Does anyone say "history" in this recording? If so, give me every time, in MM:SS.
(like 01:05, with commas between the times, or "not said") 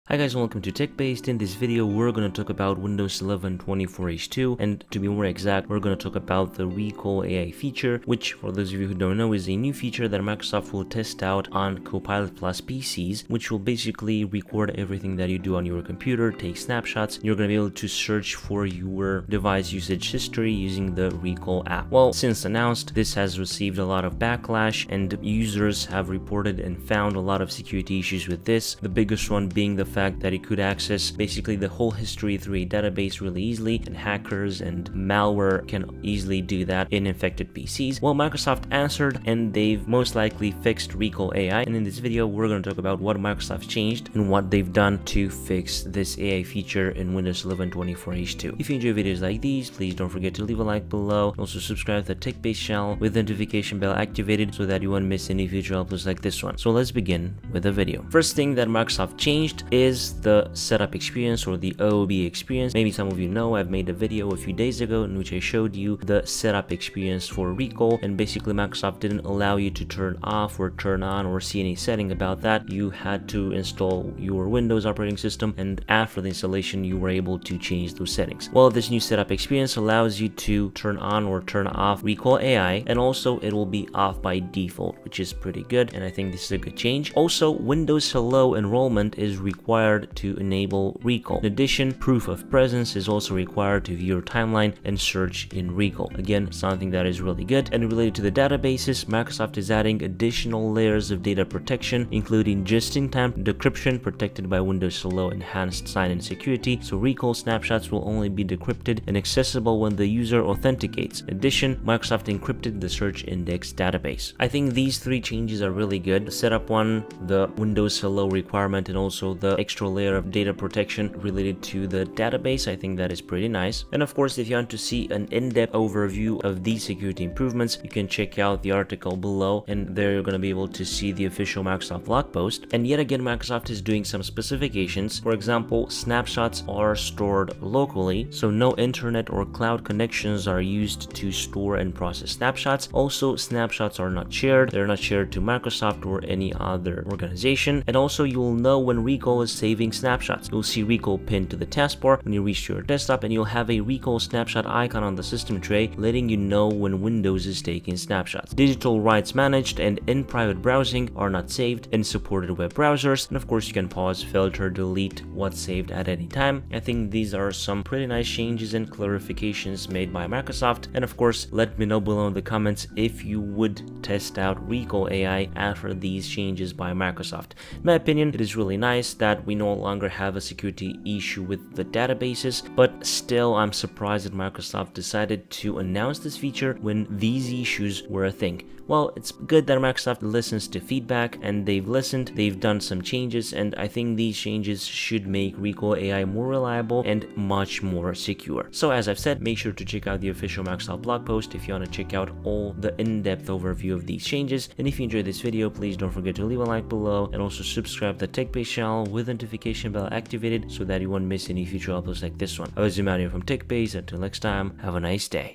00:20, 00:32.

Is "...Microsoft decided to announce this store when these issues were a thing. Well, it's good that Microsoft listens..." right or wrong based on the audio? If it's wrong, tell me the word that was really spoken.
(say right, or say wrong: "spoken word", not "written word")
wrong: "feature", not "store".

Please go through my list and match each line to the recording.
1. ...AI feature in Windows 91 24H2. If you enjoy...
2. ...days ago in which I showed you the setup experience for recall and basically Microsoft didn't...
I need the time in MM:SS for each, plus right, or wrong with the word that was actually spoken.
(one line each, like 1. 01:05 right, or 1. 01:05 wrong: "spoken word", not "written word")
1. 00:46 wrong: "11", not "91"
2. 01:04 right.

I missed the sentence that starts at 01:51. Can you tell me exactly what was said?
In addition, Microsoft encrypted the search index database.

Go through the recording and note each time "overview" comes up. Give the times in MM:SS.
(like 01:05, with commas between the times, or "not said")
02:05, 03:23.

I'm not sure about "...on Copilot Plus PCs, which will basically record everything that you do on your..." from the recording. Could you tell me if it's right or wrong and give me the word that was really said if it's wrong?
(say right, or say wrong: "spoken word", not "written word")
right.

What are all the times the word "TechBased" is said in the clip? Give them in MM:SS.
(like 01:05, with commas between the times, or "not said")
00:00, 00:52, 03:28, 03:33.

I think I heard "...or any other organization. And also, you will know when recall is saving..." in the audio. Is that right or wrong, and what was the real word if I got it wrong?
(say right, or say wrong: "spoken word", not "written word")
right.